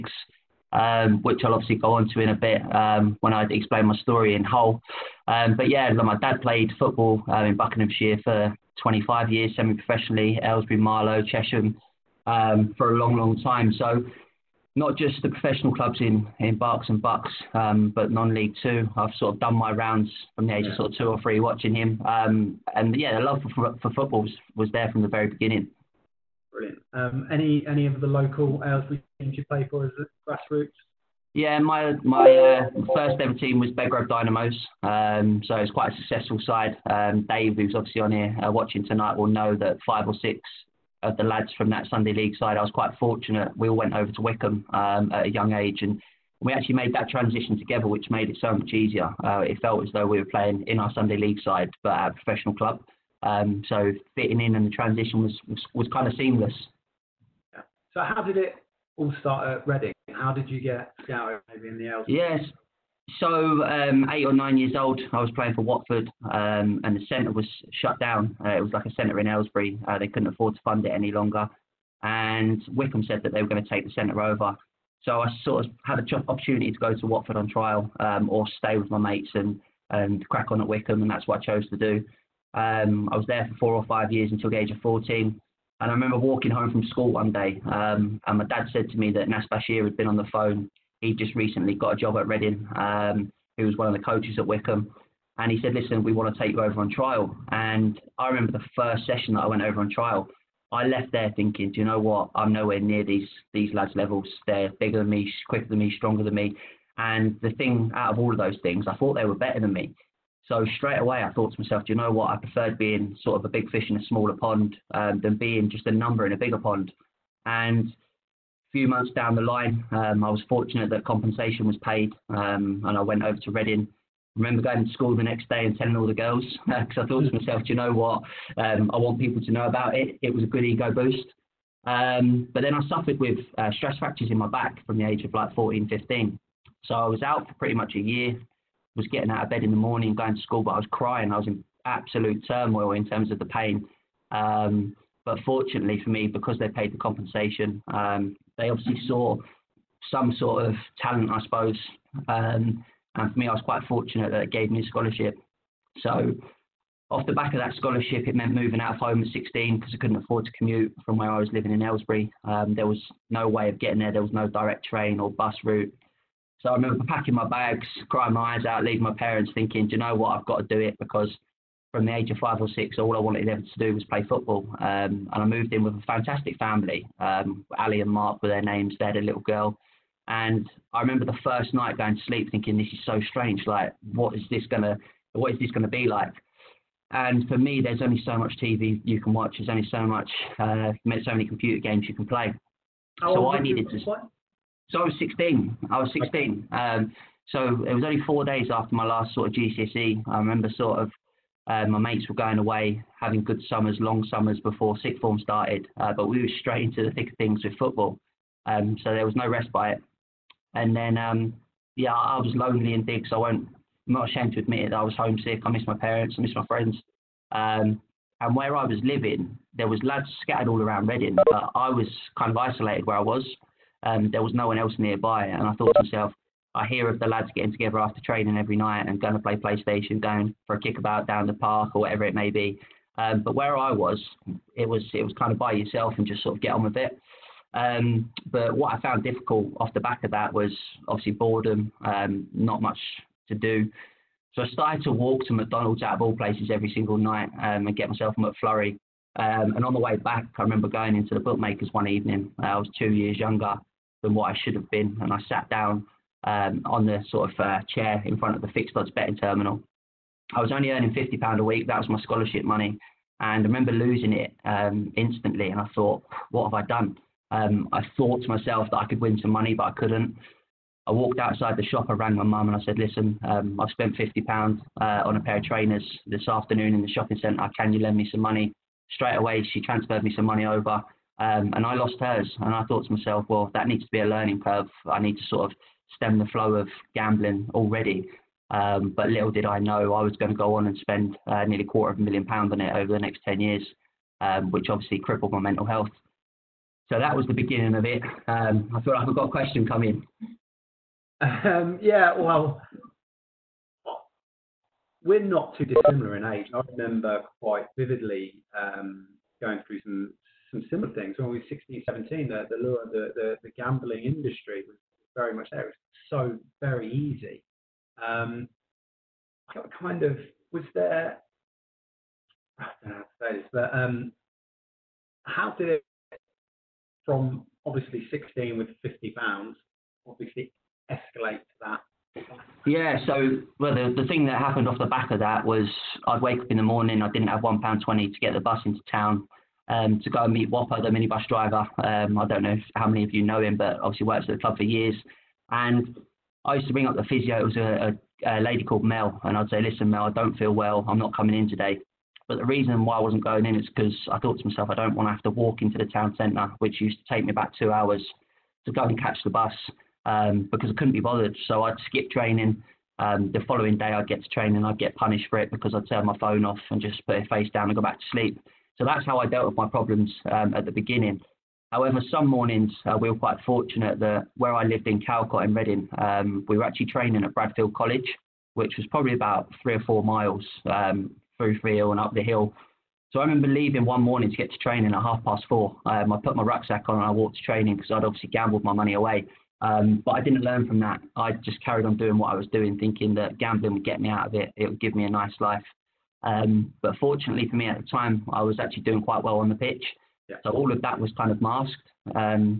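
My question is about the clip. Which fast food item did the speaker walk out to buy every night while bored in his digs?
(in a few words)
McFlurry.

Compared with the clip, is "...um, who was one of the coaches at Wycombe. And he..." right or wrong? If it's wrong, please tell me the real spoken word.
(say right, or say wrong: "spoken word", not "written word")
right.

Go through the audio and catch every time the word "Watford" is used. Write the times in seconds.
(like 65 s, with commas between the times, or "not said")
65 s, 77 s.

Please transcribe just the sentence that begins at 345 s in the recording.
And I used to bring up the physio.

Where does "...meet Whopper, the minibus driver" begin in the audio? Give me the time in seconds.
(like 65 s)
340 s.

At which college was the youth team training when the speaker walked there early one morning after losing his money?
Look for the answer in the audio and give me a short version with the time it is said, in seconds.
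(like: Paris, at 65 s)
Bradfield College, at 377 s.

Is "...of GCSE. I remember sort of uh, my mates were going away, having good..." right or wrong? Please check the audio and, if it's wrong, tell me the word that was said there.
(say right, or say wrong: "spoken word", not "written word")
right.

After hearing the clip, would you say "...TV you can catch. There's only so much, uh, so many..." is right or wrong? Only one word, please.
wrong.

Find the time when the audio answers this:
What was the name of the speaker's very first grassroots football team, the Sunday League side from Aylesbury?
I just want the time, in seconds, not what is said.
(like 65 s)
33 s.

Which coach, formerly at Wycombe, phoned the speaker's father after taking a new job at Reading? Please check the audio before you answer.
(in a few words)
Nas Bashir.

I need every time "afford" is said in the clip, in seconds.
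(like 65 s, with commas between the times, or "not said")
70 s, 160 s.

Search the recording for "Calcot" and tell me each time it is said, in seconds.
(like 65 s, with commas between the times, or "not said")
375 s.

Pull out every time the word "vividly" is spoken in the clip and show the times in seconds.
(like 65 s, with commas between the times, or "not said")
307 s.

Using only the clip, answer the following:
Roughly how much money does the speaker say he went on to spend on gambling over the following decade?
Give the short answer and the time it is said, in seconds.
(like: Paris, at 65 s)
nearly a quarter of a million pounds, at 291 s.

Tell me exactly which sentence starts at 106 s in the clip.
And the thing out of all of those things, I thought they were better than me.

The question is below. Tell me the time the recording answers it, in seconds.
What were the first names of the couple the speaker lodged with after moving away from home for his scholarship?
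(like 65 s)
177 s.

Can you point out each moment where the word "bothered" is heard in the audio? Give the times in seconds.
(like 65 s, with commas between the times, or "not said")
361 s.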